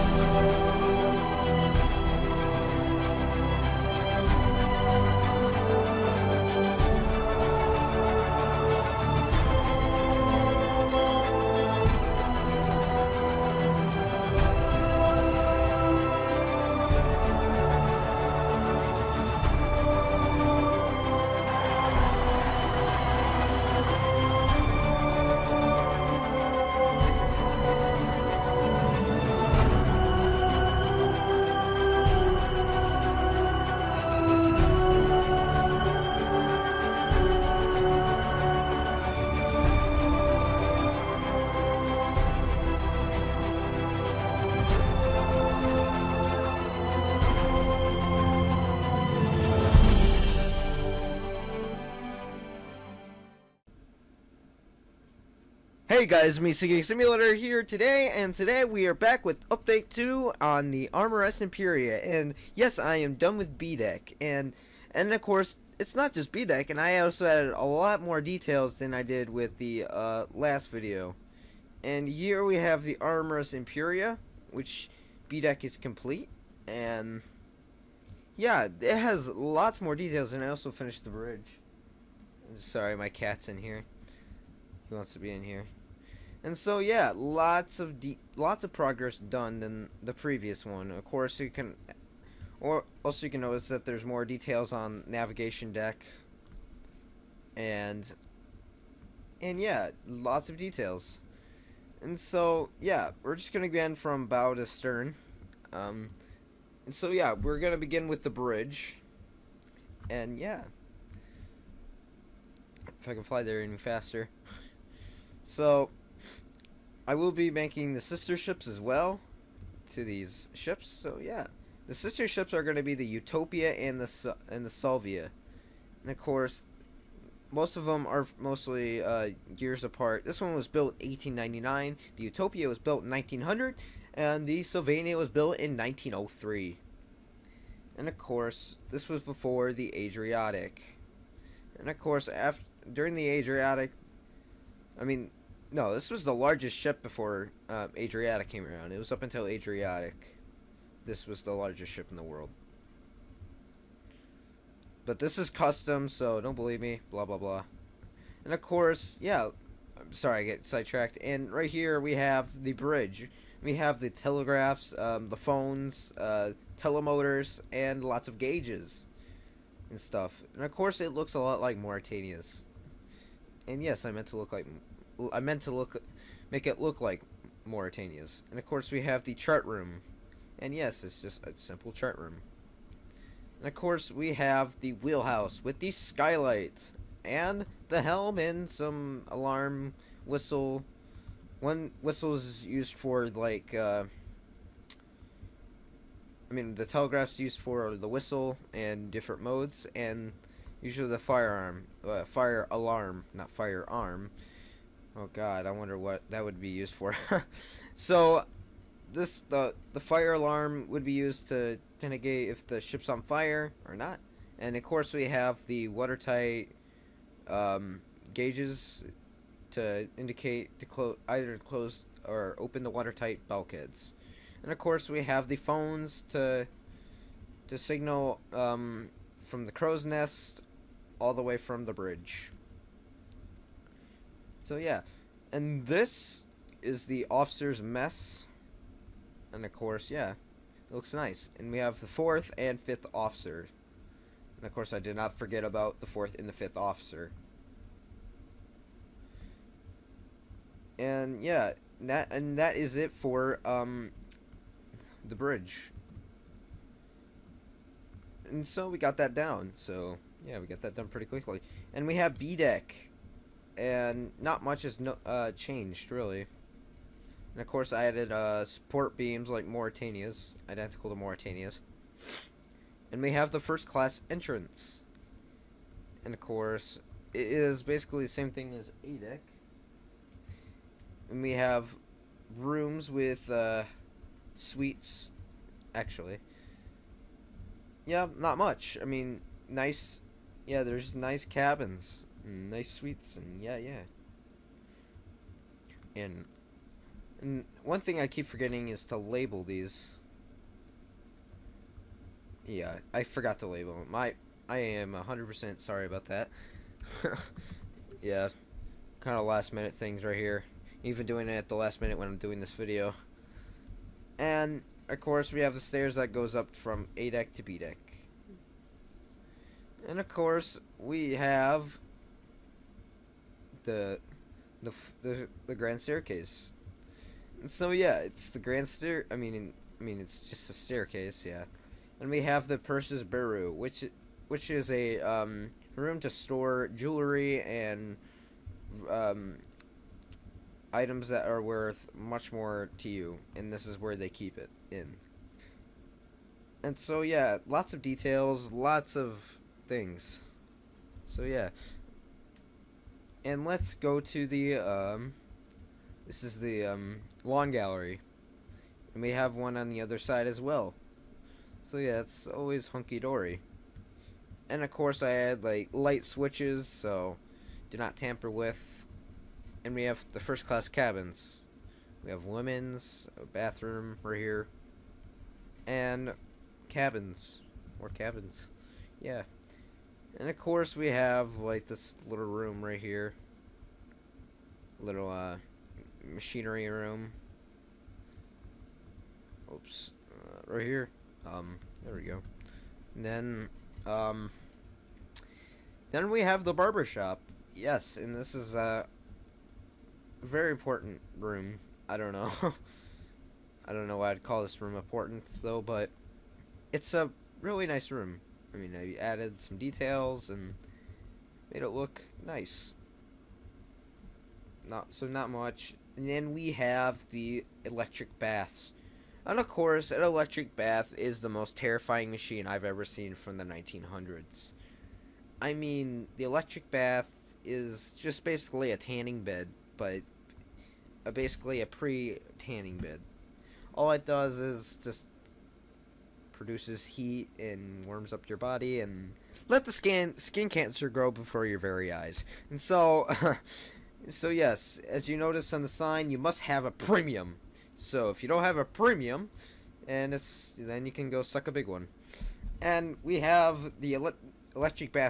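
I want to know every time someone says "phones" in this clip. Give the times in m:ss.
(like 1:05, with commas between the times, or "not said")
2:45, 3:45.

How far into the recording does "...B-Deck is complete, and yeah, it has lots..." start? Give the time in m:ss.
1:15.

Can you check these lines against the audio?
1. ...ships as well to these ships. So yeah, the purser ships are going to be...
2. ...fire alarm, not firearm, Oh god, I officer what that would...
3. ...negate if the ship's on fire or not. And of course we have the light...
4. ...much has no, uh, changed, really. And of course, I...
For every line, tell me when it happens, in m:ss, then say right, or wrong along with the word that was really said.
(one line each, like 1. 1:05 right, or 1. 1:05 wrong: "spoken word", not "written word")
1. 1:58 wrong: "sister", not "purser"
2. 3:22 wrong: "wonder", not "officer"
3. 3:32 wrong: "watertight", not "light"
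4. 4:24 right.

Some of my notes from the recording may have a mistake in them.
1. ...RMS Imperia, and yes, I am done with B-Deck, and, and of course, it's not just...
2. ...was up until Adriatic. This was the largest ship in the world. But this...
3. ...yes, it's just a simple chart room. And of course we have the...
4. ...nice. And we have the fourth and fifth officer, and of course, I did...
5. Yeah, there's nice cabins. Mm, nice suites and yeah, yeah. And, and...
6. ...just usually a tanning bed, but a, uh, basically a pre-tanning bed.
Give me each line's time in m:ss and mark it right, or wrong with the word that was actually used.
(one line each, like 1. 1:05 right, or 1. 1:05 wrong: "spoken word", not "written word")
1. 1:00 right
2. 2:28 right
3. 3:00 right
4. 4:01 right
5. 4:50 right
6. 7:08 wrong: "basically", not "usually".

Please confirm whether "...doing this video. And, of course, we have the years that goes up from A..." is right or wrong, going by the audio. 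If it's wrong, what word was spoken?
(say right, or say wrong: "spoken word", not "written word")
wrong: "stairs", not "years".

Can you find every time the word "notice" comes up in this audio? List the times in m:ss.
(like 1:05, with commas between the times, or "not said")
1:33, 7:25.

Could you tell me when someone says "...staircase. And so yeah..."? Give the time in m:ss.
5:26.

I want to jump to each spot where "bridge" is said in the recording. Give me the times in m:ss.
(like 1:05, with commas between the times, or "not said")
1:21, 1:48, 2:42, 3:51, 4:15.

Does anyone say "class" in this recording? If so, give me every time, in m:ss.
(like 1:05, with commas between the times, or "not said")
4:33, 6:10.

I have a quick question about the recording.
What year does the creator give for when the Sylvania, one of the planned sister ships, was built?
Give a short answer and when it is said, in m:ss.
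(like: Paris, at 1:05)
1903, at 2:15.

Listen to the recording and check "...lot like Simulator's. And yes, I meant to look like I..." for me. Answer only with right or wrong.
wrong.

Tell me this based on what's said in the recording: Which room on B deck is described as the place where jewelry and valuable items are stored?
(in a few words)
purser's bureau.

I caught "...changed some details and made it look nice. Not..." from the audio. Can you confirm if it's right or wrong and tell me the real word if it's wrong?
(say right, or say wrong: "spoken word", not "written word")
wrong: "added", not "changed".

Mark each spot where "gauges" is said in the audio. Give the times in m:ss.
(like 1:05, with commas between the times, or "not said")
2:48, 3:38.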